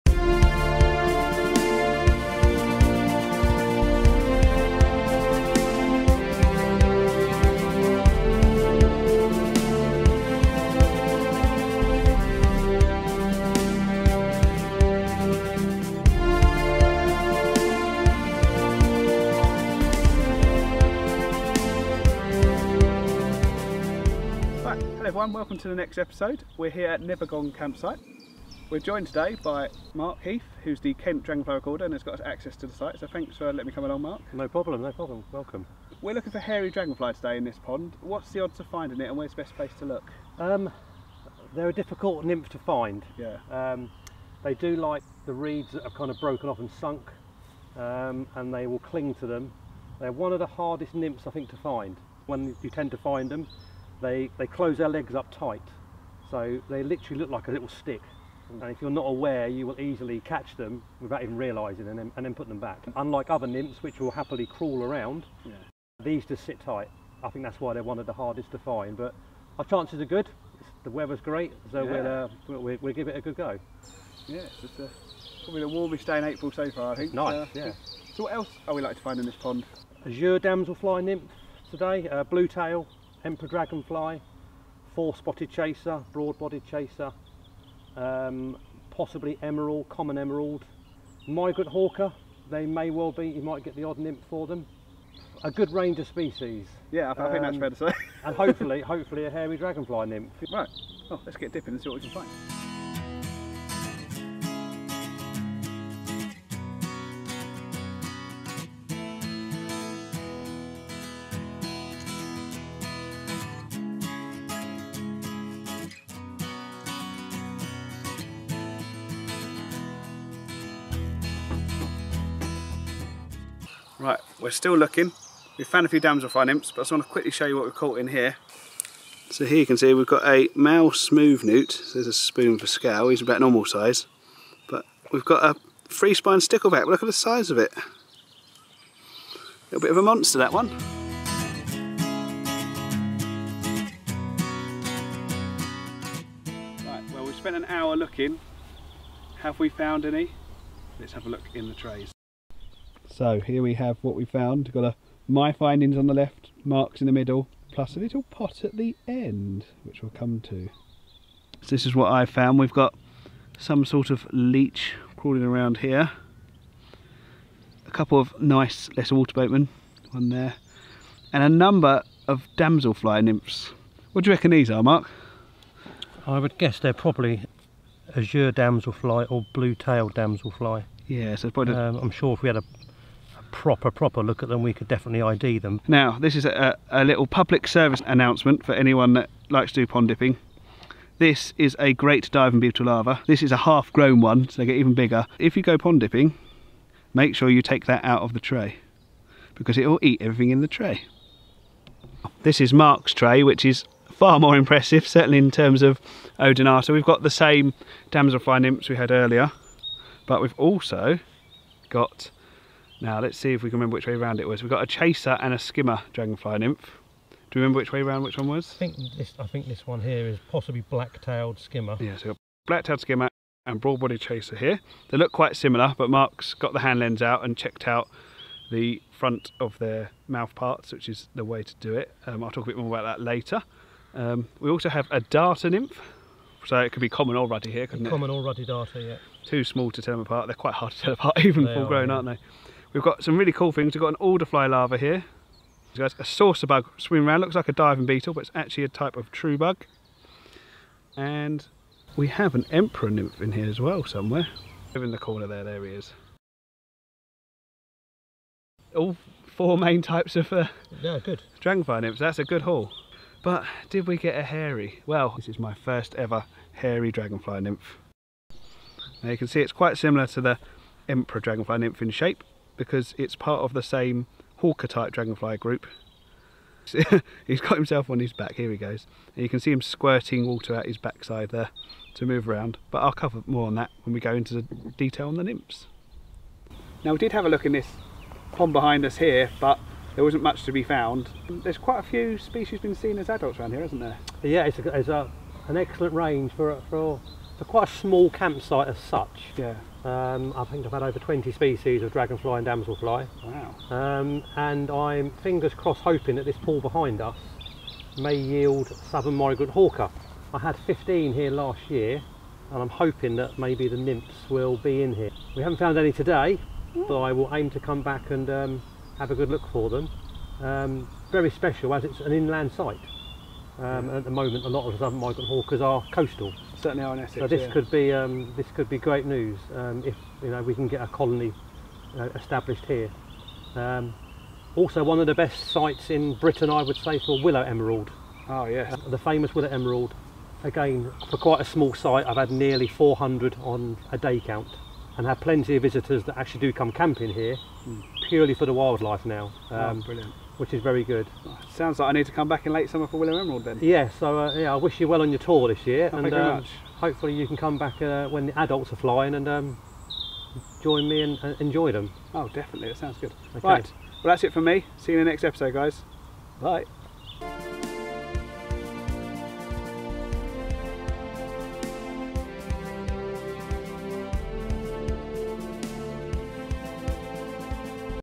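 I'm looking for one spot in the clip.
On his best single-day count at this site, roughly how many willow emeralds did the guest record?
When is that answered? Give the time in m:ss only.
5:42.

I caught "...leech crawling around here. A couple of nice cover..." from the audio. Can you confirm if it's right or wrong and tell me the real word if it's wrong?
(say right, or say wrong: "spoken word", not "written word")
wrong: "lesser", not "cover".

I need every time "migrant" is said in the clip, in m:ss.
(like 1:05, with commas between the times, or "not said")
1:31, 5:09, 5:25.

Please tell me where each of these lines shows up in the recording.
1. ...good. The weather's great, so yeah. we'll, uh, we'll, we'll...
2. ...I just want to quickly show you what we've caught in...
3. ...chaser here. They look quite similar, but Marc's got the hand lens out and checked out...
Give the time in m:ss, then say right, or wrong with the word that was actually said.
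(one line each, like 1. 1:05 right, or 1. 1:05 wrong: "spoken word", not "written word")
1. 1:10 right
2. 2:06 right
3. 3:44 right.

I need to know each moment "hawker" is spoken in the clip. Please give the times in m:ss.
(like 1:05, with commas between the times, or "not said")
1:31, 4:34, 5:09, 5:25.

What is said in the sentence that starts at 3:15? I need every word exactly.
If you go pond dipping, make sure you take that out of the tray because it will eat everything in the tray.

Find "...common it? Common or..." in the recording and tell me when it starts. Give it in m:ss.
3:58.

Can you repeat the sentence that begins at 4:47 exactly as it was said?
Now we did have a look in this pond behind us here, but there wasn't much to be found.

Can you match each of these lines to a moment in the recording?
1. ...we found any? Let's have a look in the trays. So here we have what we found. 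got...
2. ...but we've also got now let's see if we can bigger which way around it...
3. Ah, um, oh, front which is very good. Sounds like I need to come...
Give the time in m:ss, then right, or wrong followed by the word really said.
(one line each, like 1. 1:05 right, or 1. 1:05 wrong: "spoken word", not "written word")
1. 2:29 right
2. 3:30 wrong: "remember", not "bigger"
3. 5:49 wrong: "brilliant", not "front".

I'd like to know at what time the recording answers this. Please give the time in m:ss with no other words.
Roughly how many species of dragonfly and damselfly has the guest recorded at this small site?
5:01.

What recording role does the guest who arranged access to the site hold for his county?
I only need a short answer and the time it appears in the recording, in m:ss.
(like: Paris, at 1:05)
Kent Dragonfly Recorder, at 0:30.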